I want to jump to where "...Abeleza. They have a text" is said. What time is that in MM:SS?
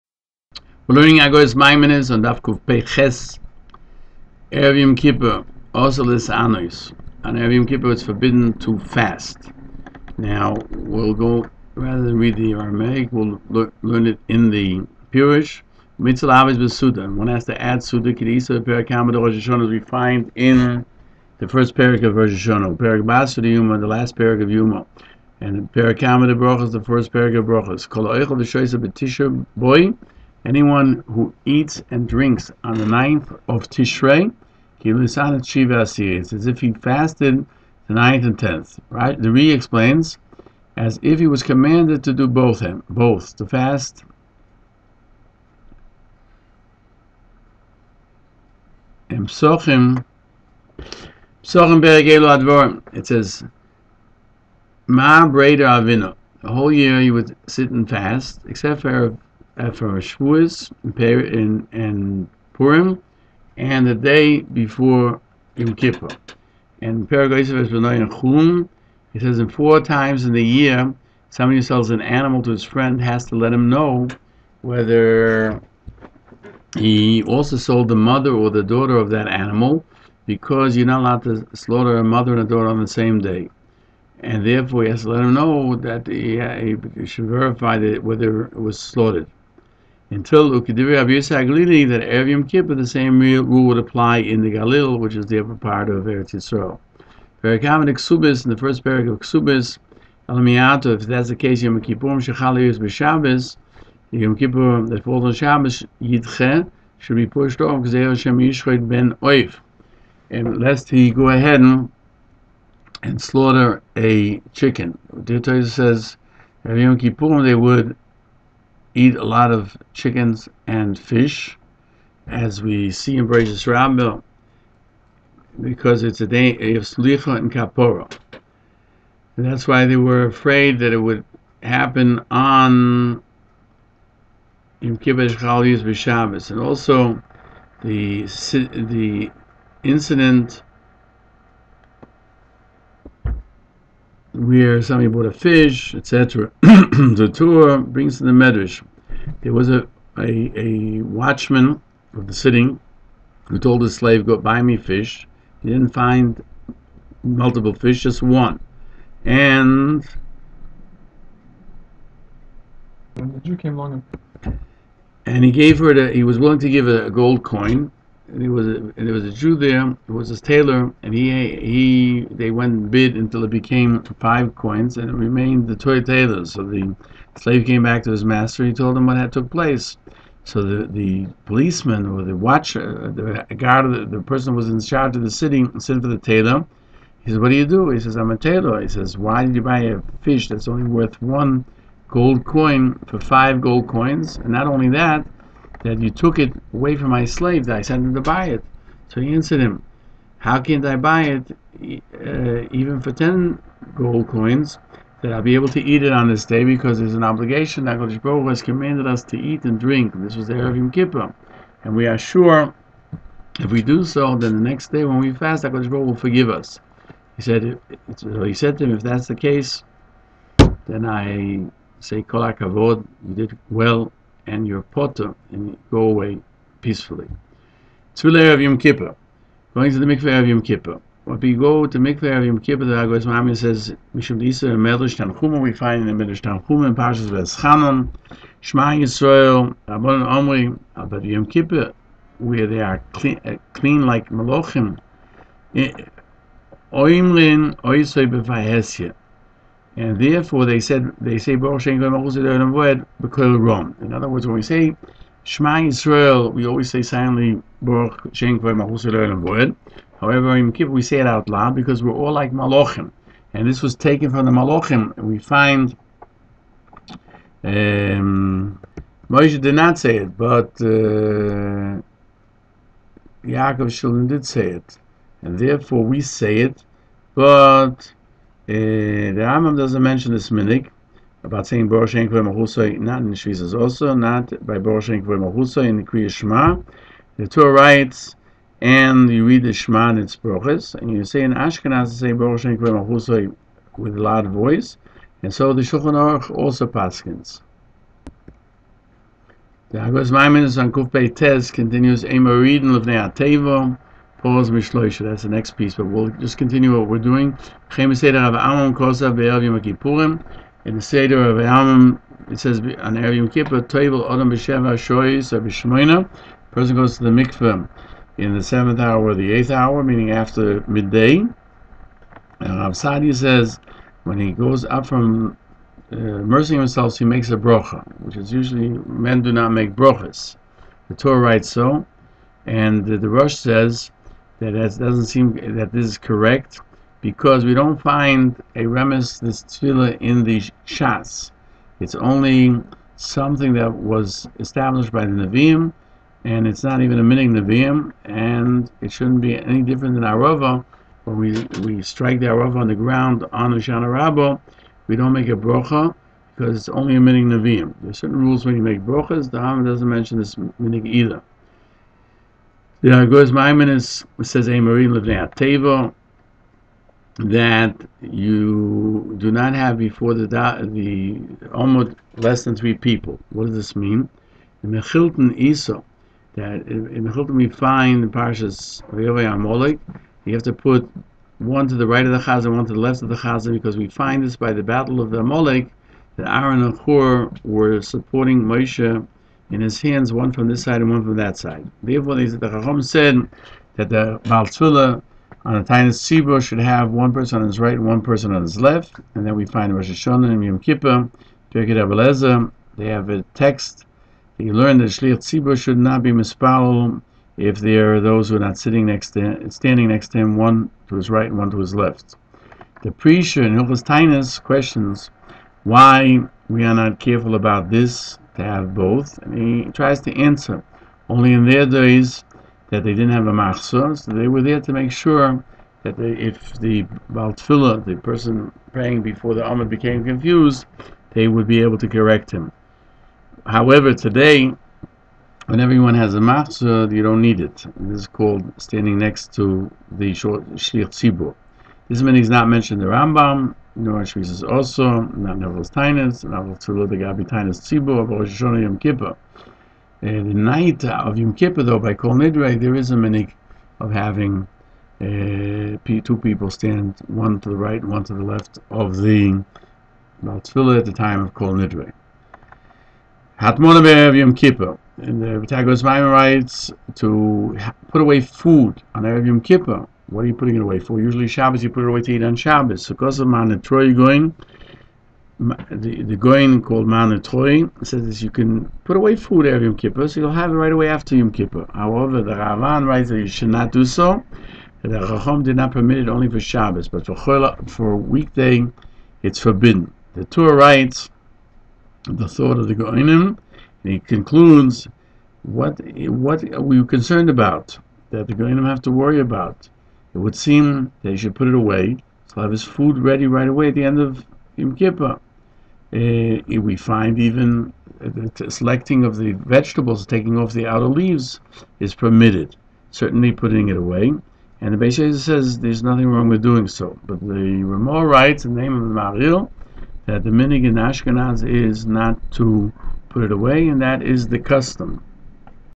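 06:41.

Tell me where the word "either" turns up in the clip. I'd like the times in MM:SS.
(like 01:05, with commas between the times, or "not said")
06:01.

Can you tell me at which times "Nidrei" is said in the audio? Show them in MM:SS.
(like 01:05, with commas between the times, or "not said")
07:32, 07:41.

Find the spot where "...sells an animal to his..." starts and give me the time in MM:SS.
01:11.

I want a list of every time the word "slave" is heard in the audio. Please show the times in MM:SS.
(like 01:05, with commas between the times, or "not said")
02:33, 02:57, 03:17.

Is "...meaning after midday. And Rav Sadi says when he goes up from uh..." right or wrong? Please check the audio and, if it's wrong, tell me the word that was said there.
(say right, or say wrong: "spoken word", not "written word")
right.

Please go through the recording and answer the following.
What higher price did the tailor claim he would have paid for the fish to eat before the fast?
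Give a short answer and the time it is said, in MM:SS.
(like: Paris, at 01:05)
10 gold coins, at 03:23.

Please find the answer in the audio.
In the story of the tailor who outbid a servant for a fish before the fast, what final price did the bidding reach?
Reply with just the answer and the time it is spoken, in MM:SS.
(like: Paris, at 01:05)
5 gold coins, at 02:54.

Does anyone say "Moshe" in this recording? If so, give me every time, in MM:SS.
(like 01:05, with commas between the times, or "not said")
04:29, 06:28.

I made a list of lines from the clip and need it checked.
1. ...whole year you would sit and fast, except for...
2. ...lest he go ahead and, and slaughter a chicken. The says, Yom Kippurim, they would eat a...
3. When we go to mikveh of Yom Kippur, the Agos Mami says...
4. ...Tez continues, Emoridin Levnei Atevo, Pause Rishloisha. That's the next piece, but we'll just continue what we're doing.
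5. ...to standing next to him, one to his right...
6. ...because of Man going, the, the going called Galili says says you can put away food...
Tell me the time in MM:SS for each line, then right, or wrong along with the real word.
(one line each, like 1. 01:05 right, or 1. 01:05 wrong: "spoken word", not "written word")
1. 00:56 right
2. 01:50 right
3. 03:51 right
4. 05:01 right
5. 06:49 right
6. 07:53 wrong: "Man", not "Galili".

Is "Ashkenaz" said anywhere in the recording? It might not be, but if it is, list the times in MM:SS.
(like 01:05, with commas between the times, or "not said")
04:51, 08:40.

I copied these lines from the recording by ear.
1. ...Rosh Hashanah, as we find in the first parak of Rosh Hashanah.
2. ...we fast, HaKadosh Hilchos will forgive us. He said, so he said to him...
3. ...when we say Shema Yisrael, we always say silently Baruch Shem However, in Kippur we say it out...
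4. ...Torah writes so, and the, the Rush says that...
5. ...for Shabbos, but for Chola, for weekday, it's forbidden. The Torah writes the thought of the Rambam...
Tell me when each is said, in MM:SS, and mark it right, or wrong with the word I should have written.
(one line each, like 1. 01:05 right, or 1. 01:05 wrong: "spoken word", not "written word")
1. 00:19 right
2. 03:35 wrong: "Baruch", not "Hilchos"
3. 04:14 right
4. 05:31 right
5. 08:06 wrong: "Goinim", not "Rambam".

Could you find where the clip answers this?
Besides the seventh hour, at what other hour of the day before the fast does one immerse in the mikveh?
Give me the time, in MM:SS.
05:15.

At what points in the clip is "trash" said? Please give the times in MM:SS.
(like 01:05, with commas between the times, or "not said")
not said.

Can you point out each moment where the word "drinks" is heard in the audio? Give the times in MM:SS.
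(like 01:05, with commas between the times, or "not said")
00:32, 03:29.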